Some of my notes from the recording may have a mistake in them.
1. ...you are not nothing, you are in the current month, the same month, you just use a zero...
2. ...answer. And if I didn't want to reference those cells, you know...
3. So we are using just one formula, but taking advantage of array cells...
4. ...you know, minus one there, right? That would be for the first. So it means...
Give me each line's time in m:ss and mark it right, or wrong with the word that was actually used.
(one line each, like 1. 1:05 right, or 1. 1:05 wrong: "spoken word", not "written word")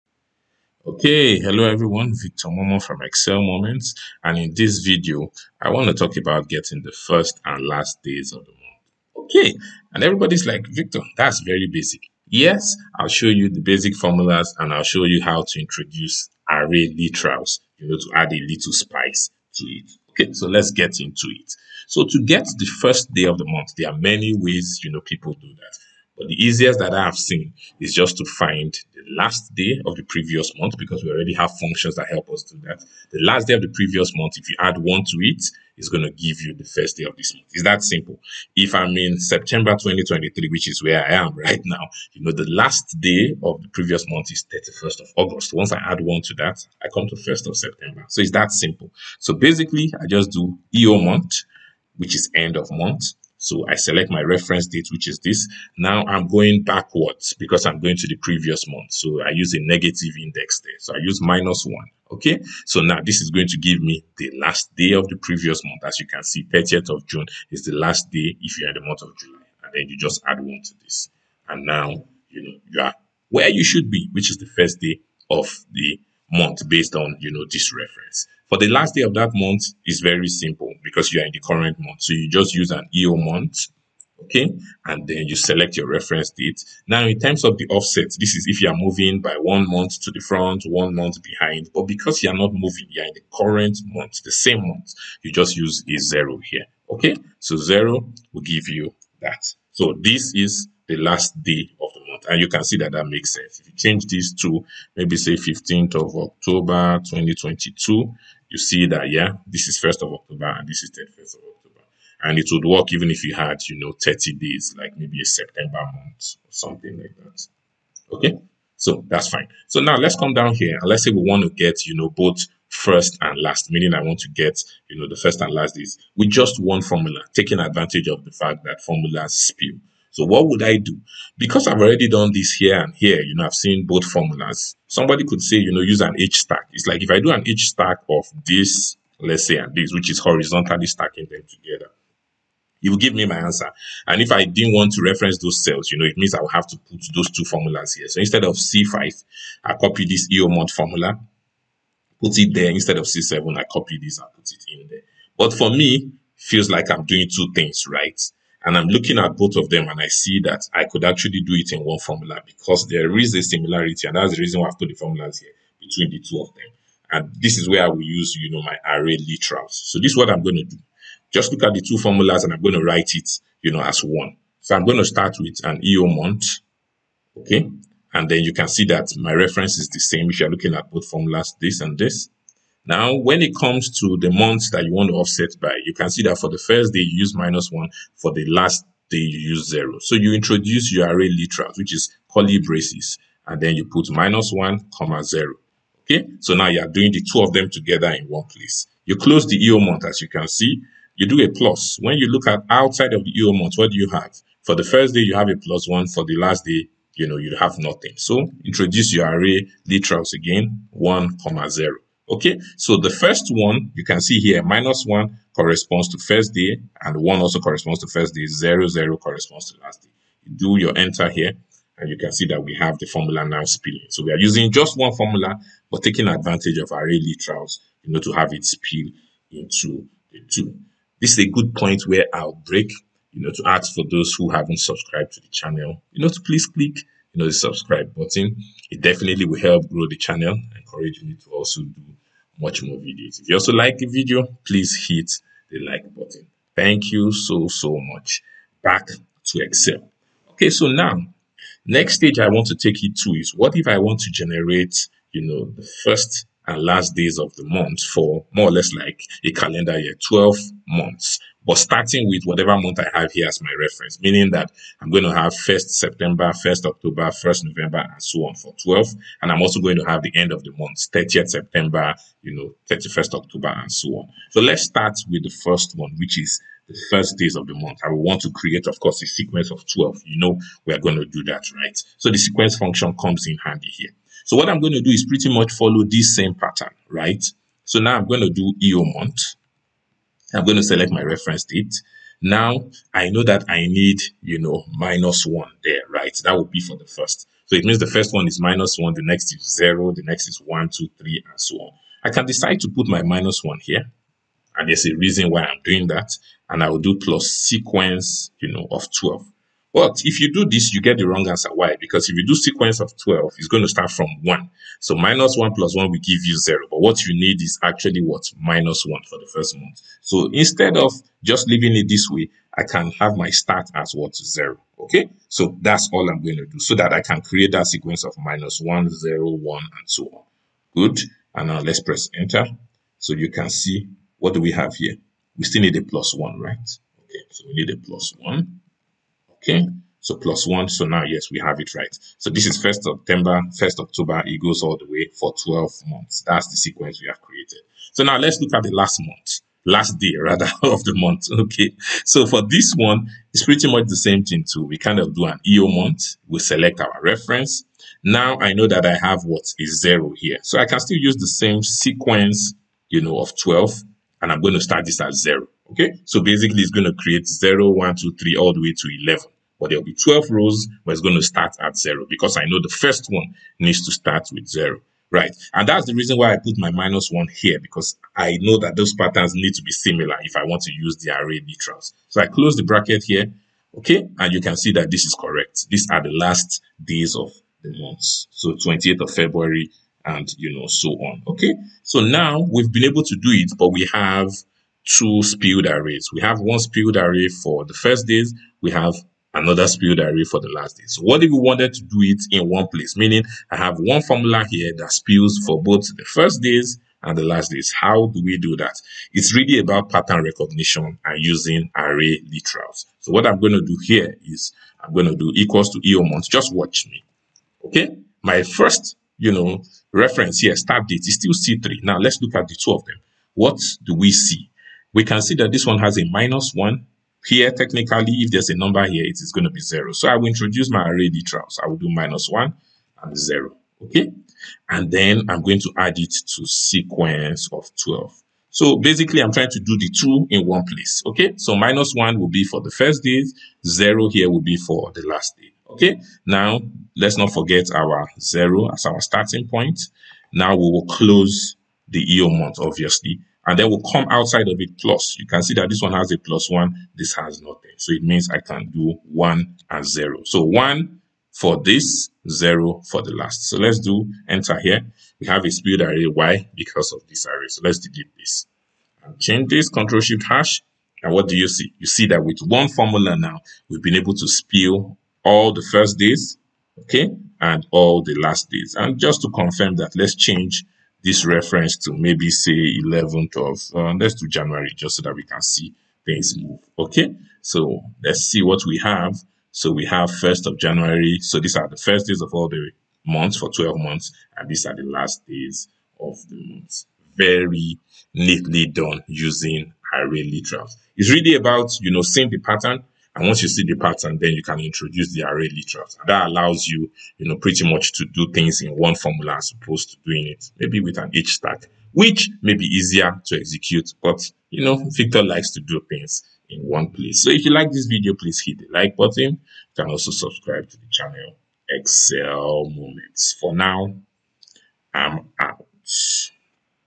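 1. 1:32 wrong: "moving", not "nothing"
2. 2:23 right
3. 3:44 wrong: "literals", not "cells"
4. 4:54 right.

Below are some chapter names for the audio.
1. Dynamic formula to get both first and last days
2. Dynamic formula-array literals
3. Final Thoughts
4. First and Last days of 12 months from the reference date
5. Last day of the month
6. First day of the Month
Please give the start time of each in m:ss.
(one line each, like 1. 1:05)
1. 2:04
2. 2:44
3. 8:20
4. 4:18
5. 1:20
6. 0:24.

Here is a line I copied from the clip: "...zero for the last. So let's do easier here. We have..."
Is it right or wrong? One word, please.
wrong.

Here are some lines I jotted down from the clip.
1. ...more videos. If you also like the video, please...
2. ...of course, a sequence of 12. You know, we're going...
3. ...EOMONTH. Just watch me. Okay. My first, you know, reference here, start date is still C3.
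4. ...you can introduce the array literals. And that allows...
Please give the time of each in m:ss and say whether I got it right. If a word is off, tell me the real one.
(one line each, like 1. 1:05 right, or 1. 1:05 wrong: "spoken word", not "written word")
1. 4:02 right
2. 4:38 right
3. 6:55 right
4. 8:24 right.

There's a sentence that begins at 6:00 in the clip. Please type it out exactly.
So I can still use the same sequence, you know, of 12 and I'm going to start this at zero.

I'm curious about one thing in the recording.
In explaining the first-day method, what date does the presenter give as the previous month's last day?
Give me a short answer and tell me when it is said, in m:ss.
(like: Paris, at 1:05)
31st of August, at 0:44.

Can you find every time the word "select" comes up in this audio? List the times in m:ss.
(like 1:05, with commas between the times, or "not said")
0:53, 1:25, 4:50, 5:56.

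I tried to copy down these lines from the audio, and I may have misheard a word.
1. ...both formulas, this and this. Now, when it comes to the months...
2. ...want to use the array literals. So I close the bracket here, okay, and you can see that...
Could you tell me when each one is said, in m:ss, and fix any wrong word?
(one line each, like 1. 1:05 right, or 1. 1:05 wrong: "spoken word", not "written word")
1. 3:00 right
2. 6:20 right.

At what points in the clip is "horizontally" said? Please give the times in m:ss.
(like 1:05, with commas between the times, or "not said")
2:20.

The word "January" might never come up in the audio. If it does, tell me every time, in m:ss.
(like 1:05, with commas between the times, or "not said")
8:04, 8:10.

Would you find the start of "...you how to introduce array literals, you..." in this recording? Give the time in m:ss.
0:15.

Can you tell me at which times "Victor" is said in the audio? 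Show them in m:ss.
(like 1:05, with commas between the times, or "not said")
0:02, 0:10, 8:35.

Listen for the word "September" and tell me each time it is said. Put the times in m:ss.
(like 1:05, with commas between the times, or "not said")
0:39, 0:47, 1:55, 4:25, 4:31, 5:43.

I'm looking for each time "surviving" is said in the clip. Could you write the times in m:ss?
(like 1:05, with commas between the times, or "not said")
not said.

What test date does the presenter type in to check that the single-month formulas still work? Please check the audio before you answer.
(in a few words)
15th of October 2022.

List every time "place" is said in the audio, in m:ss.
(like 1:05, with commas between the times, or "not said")
3:18, 6:42, 7:20, 8:37.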